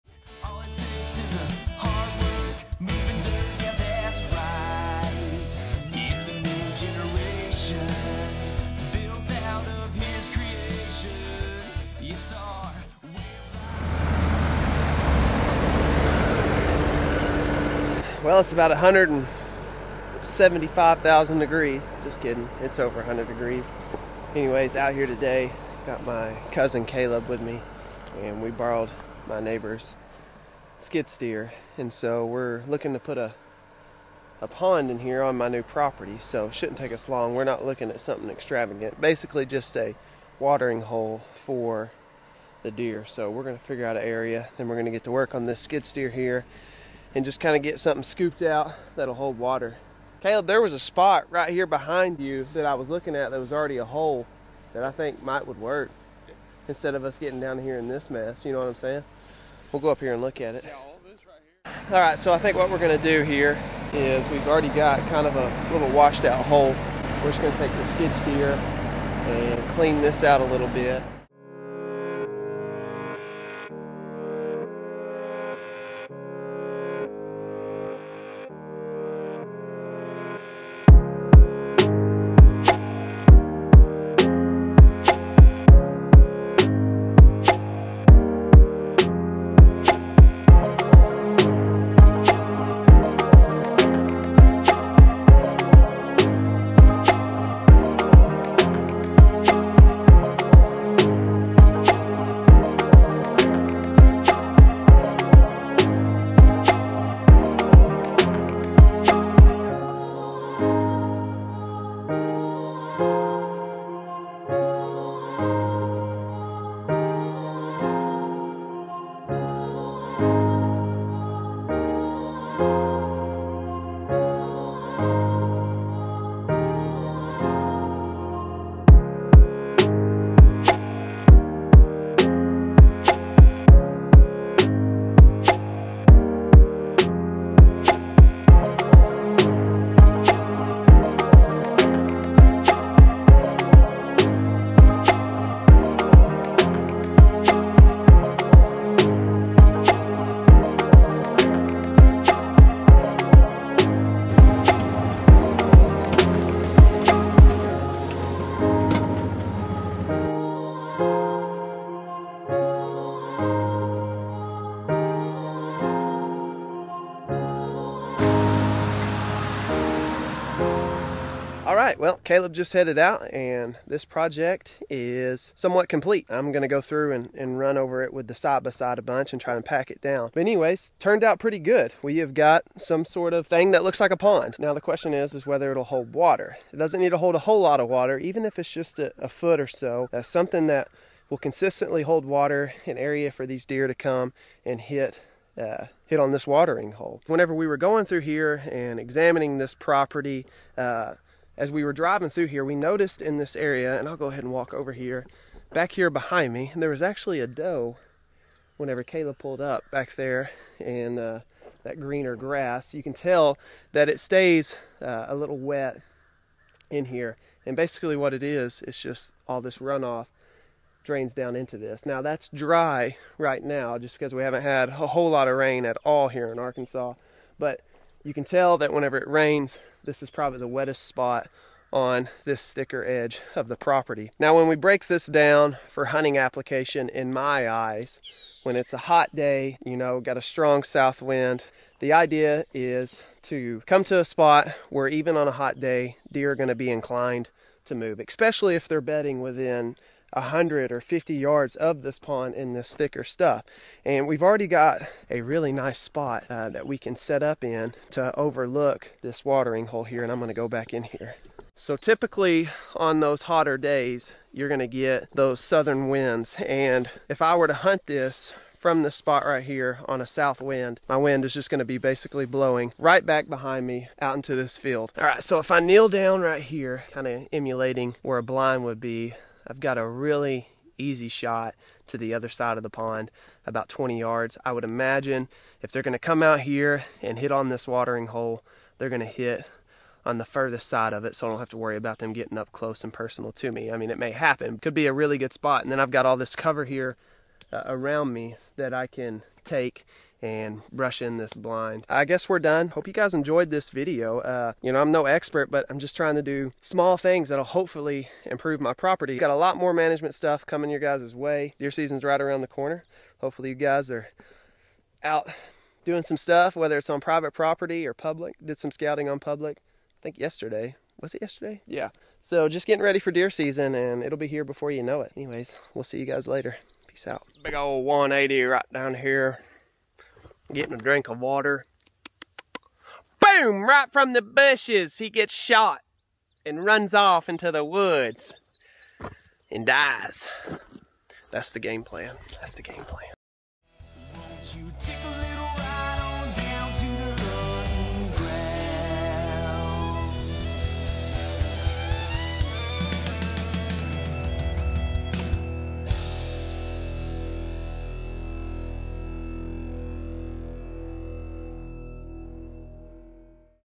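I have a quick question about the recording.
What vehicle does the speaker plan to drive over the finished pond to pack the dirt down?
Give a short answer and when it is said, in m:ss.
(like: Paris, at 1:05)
Side by side, at 2:58.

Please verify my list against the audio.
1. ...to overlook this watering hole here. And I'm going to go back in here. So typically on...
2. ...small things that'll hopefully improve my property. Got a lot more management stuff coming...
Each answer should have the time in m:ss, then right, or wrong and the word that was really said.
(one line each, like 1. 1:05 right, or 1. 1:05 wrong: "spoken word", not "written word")
1. 4:18 right
2. 5:06 right.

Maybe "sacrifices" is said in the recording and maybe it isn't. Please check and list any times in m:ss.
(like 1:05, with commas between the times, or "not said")
not said.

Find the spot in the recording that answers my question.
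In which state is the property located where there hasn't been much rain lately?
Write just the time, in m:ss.
3:46.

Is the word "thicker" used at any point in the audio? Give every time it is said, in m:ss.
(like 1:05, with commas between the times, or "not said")
3:52, 4:12.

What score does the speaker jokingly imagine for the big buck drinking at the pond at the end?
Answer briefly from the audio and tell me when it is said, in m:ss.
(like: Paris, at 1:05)
180, at 5:28.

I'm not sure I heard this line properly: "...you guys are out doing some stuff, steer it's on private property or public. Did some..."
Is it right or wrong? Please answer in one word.
wrong.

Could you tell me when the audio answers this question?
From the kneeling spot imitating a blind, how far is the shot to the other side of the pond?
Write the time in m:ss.
4:43.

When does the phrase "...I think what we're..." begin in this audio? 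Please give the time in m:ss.
1:02.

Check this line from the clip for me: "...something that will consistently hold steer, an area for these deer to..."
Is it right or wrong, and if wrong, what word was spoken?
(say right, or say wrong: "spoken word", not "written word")
wrong: "water", not "steer".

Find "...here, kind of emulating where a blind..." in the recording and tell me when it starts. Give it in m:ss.
4:36.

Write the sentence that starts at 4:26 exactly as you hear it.
And if I were to hunt this from this spot right here on a south wind.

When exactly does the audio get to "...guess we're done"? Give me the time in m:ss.
5:02.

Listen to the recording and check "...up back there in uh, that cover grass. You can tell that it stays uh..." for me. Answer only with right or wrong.
wrong.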